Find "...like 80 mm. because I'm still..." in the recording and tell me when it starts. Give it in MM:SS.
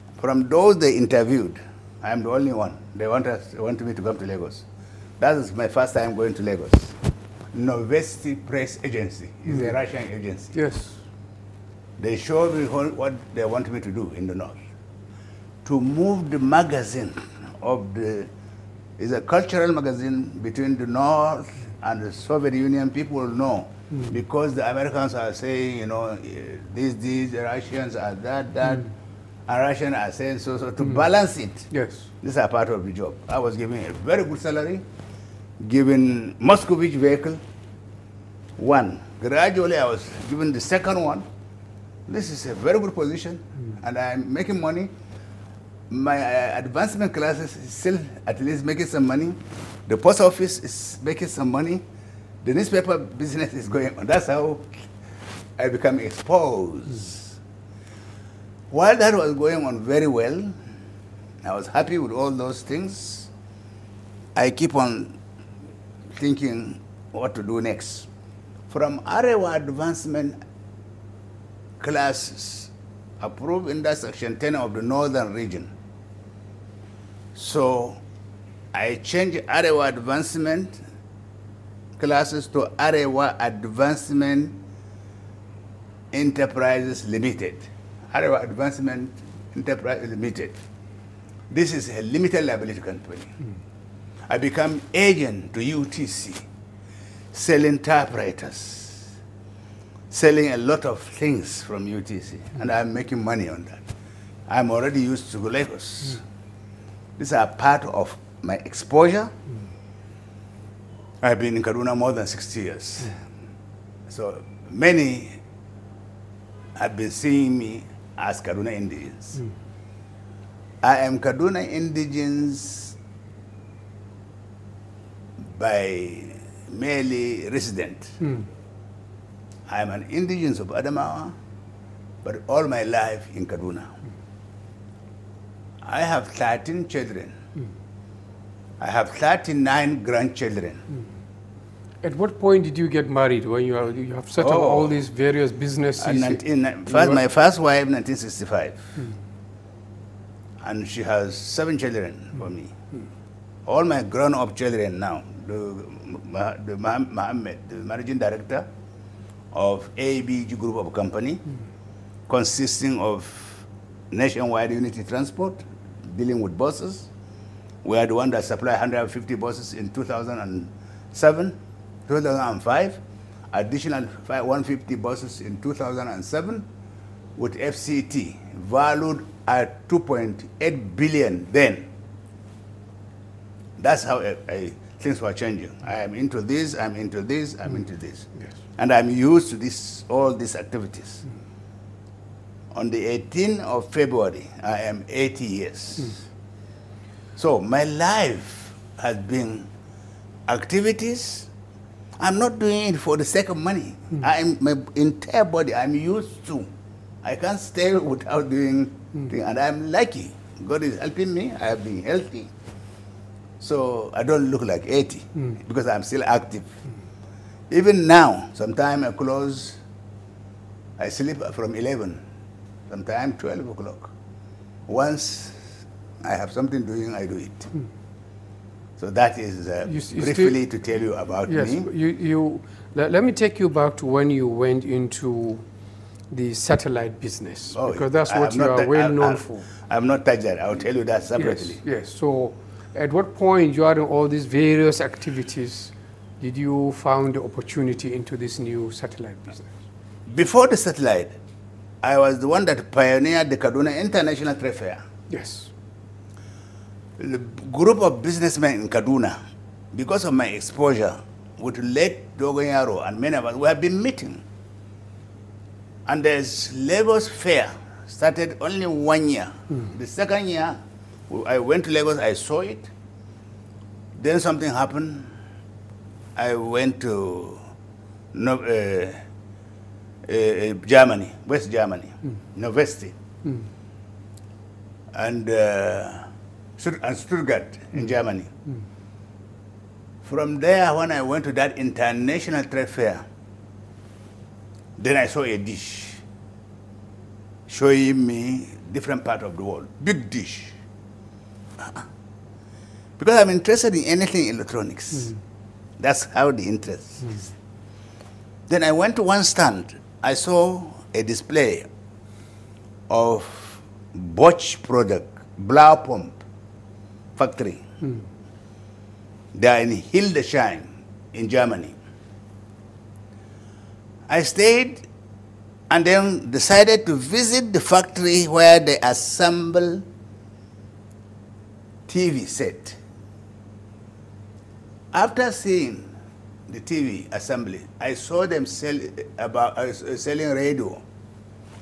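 03:34.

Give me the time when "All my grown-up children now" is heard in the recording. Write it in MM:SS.
02:33.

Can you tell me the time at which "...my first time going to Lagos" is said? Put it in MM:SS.
00:05.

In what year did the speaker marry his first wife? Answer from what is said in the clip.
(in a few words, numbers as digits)
1965.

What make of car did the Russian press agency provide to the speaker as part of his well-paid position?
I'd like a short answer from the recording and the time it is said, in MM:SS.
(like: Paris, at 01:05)
Moskvitch, at 00:36.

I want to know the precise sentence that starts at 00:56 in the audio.
Mm while that was going on very well, I was happy with all those things.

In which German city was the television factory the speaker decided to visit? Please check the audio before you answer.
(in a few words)
Hildesheim.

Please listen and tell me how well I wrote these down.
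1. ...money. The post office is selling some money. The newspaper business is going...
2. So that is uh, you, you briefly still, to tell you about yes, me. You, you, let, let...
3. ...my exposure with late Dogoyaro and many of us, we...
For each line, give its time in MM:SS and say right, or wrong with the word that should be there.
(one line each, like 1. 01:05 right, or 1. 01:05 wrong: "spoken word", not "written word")
1. 00:49 wrong: "making", not "selling"
2. 03:48 right
3. 04:20 right.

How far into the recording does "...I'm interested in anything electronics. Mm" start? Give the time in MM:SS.
05:03.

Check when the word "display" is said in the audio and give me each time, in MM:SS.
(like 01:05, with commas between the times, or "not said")
05:11.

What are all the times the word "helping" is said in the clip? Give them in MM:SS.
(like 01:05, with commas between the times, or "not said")
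03:30.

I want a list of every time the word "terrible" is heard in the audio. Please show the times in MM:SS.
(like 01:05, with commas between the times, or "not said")
not said.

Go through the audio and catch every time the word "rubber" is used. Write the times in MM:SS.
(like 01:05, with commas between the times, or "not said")
not said.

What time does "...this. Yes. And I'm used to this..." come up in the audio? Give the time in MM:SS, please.
03:07.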